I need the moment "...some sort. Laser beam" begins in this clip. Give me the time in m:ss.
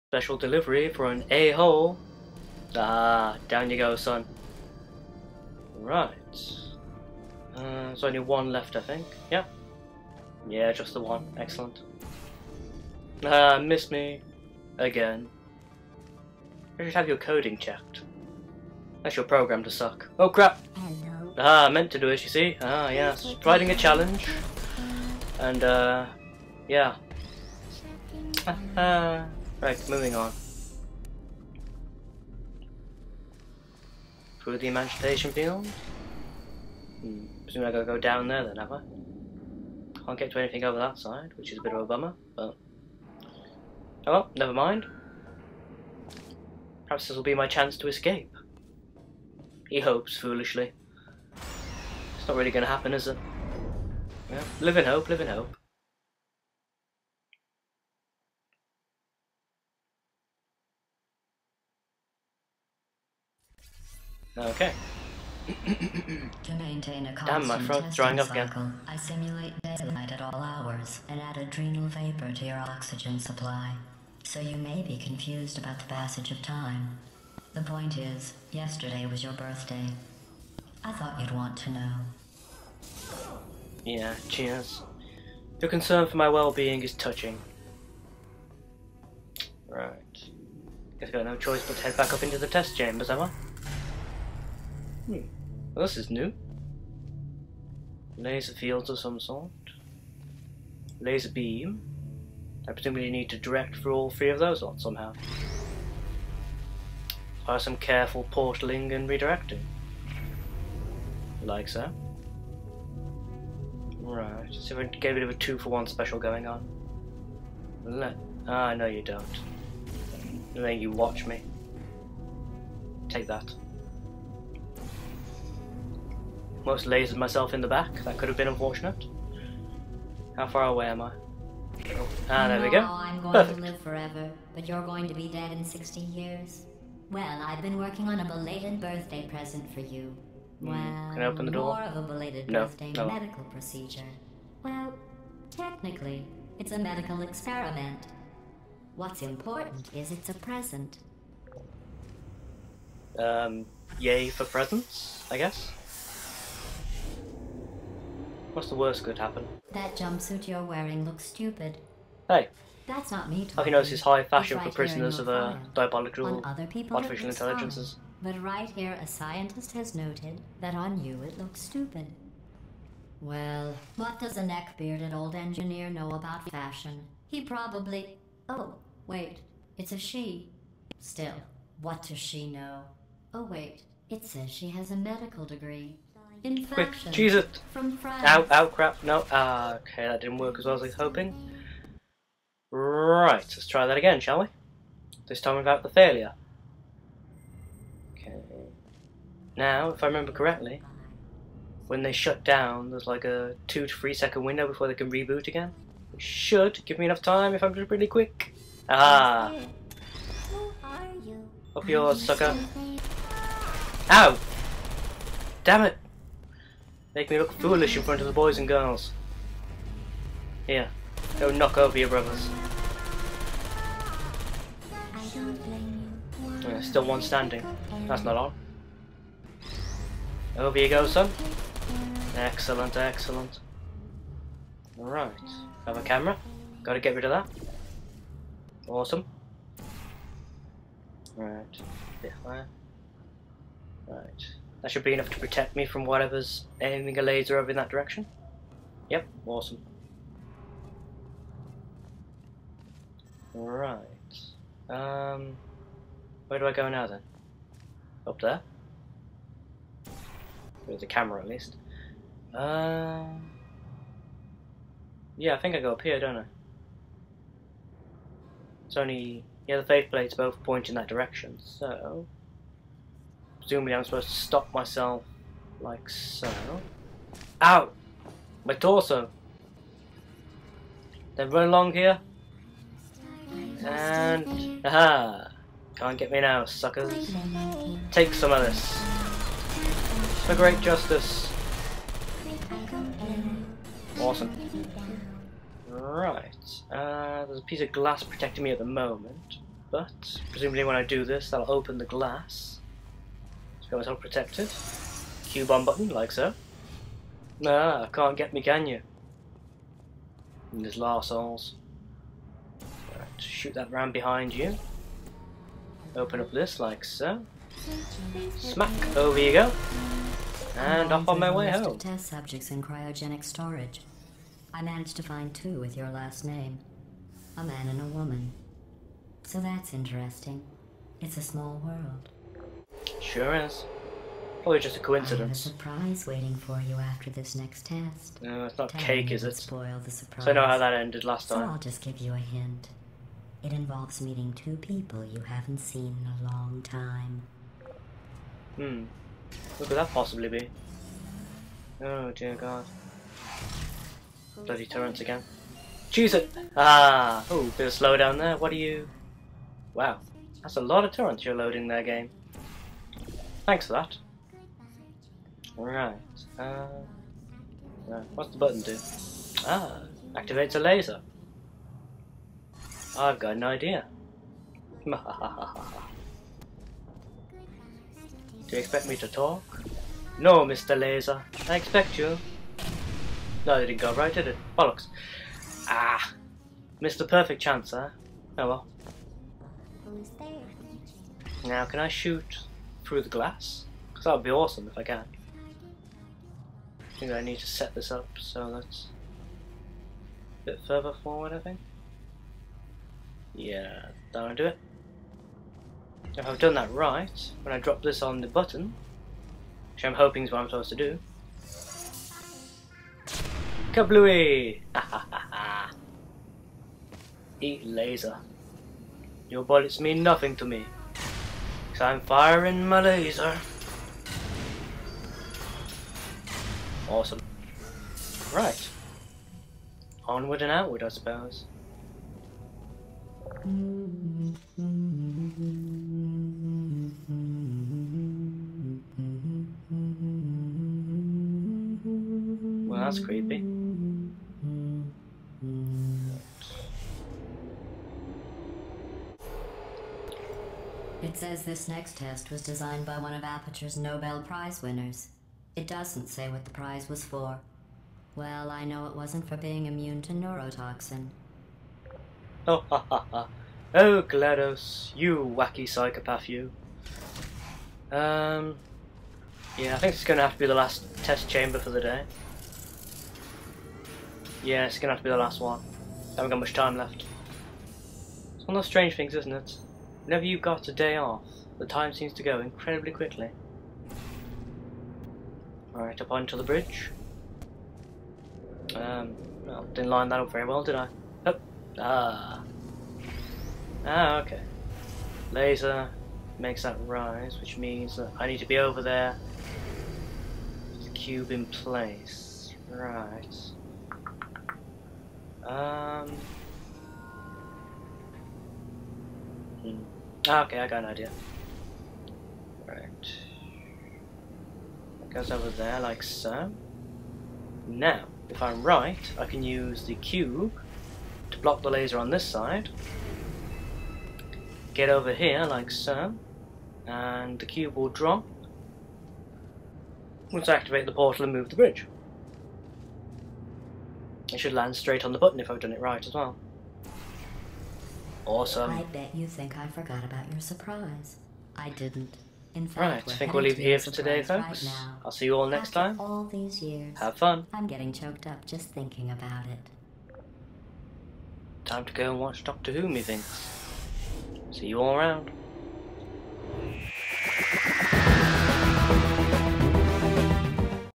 1:38.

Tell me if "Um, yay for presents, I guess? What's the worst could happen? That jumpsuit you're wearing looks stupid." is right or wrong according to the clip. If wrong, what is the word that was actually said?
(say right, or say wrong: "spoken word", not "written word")
right.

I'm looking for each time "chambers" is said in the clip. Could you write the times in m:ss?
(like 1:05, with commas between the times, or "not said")
1:32, 7:51.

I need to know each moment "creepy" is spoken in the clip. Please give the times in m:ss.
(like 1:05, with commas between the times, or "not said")
7:23.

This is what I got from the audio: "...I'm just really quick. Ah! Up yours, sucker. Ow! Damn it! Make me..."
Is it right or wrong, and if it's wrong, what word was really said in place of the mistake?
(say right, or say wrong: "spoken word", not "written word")
right.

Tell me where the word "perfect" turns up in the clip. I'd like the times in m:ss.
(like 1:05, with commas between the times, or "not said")
2:13, 6:27.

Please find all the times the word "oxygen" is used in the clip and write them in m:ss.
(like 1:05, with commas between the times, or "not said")
1:12.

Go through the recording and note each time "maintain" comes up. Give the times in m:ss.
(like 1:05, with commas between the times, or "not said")
1:06.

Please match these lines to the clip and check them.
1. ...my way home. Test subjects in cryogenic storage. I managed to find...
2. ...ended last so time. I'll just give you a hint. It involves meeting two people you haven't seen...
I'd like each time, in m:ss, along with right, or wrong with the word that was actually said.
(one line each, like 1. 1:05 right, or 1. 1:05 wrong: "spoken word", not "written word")
1. 5:21 right
2. 5:40 right.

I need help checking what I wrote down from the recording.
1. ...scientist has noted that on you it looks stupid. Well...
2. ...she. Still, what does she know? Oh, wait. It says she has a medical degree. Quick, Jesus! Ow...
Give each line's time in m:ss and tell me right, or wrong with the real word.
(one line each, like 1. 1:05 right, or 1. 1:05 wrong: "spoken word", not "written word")
1. 2:49 right
2. 2:59 right.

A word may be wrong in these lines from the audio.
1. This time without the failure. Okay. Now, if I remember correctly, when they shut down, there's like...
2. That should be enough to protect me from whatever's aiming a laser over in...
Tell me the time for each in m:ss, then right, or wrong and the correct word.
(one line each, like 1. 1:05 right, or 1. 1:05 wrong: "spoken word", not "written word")
1. 3:15 right
2. 4:04 right.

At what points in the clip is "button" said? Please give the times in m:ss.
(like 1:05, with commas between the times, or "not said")
5:05, 6:08, 6:48, 8:55.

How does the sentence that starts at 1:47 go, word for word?
By some careful portaling and redirecting.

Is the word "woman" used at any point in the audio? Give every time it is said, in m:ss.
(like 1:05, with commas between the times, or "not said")
5:28.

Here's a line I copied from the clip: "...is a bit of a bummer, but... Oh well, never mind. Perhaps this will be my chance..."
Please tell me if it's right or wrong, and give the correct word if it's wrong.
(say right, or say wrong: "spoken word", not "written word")
right.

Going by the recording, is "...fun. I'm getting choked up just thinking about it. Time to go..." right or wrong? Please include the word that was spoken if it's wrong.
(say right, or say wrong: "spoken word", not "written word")
right.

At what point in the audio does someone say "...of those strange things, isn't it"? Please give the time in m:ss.
7:58.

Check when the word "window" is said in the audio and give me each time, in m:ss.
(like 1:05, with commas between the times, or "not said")
3:24.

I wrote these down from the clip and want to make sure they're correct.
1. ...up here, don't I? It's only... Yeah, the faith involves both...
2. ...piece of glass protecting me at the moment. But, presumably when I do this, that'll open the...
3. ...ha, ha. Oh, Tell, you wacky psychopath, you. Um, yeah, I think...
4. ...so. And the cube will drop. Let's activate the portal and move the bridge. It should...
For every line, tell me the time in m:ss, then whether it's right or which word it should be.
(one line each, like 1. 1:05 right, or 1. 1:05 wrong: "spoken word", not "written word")
1. 4:25 wrong: "plates", not "involves"
2. 4:57 right
3. 7:43 wrong: "GLaDOS", not "Tell"
4. 8:45 right.